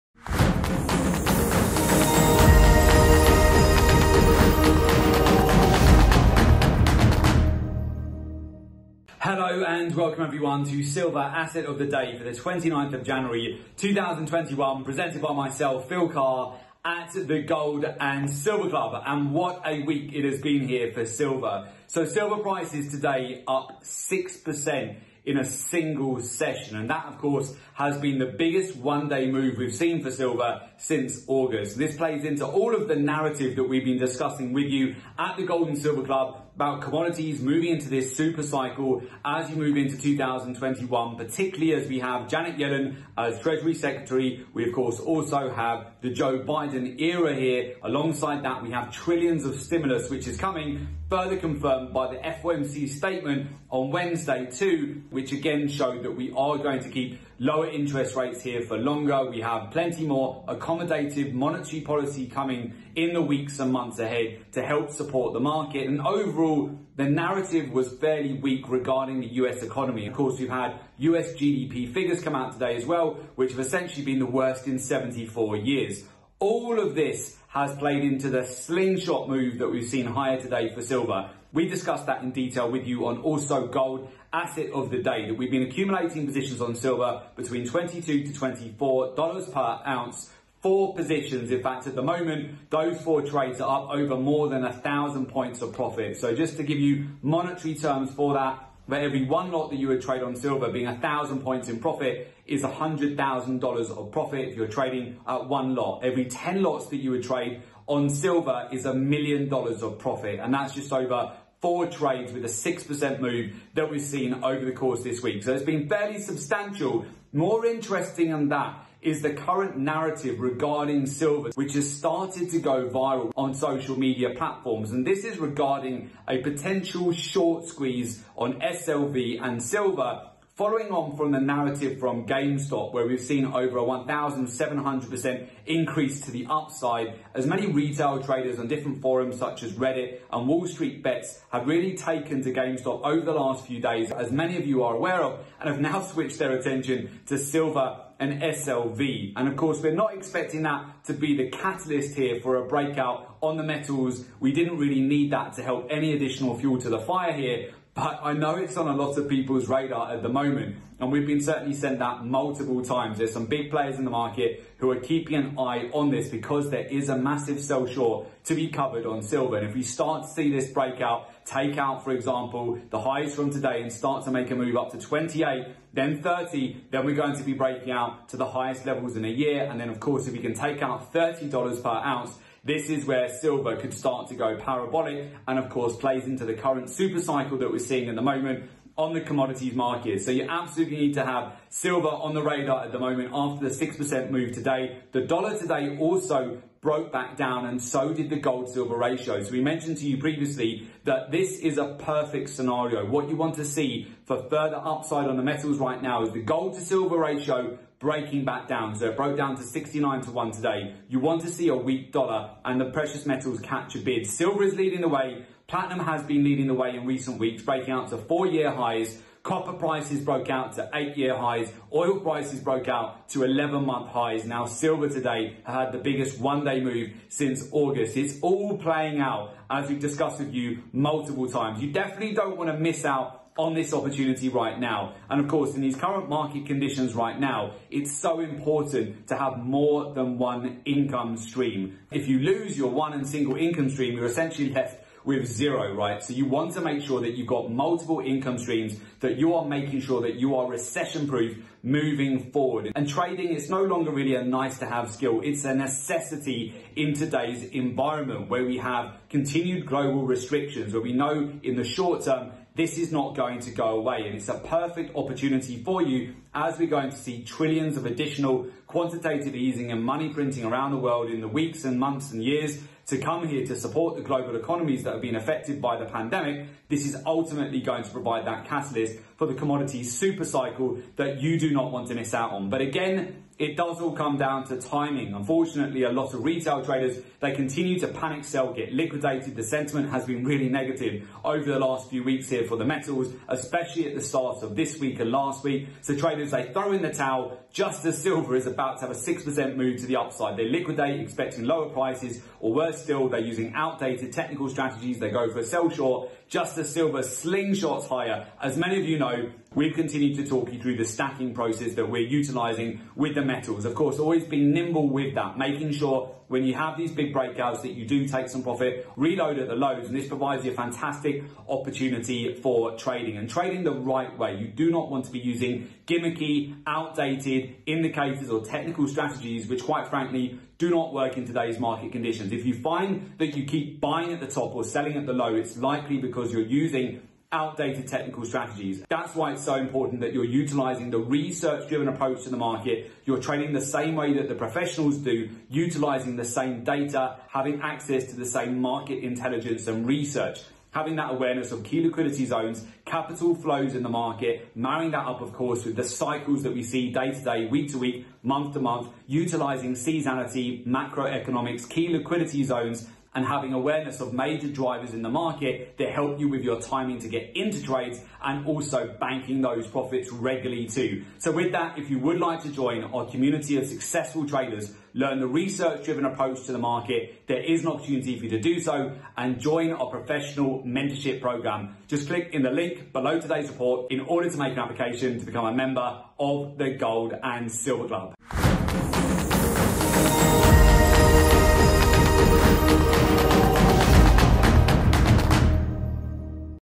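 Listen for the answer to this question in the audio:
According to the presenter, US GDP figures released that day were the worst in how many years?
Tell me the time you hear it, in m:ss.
1:14.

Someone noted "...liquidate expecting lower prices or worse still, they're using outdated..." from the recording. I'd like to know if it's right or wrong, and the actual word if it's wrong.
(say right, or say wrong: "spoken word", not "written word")
right.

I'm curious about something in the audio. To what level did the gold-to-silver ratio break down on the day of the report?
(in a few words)
69 to 1.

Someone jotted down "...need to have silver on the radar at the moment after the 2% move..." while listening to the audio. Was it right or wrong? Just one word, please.
wrong.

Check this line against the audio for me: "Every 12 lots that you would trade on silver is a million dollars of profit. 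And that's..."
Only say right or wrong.
wrong.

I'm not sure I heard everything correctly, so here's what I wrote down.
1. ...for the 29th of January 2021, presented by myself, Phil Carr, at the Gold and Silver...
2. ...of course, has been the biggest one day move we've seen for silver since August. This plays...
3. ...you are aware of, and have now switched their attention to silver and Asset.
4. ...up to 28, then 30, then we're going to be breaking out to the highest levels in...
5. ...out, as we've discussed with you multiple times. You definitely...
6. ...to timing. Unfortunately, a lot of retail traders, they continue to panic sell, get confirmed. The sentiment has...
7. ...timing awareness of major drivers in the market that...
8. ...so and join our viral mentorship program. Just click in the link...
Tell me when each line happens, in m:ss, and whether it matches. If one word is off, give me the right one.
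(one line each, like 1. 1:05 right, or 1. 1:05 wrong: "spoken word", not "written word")
1. 0:12 right
2. 0:27 right
3. 2:24 wrong: "SLV", not "Asset"
4. 2:54 right
5. 3:49 right
6. 4:44 wrong: "liquidated", not "confirmed"
7. 6:03 wrong: "having", not "timing"
8. 6:18 wrong: "professional", not "viral".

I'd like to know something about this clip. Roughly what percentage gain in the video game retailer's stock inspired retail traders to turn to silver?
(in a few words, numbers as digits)
1,700%.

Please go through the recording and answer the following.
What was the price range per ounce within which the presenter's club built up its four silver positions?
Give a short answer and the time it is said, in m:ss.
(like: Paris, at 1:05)
$22 to $24, at 1:27.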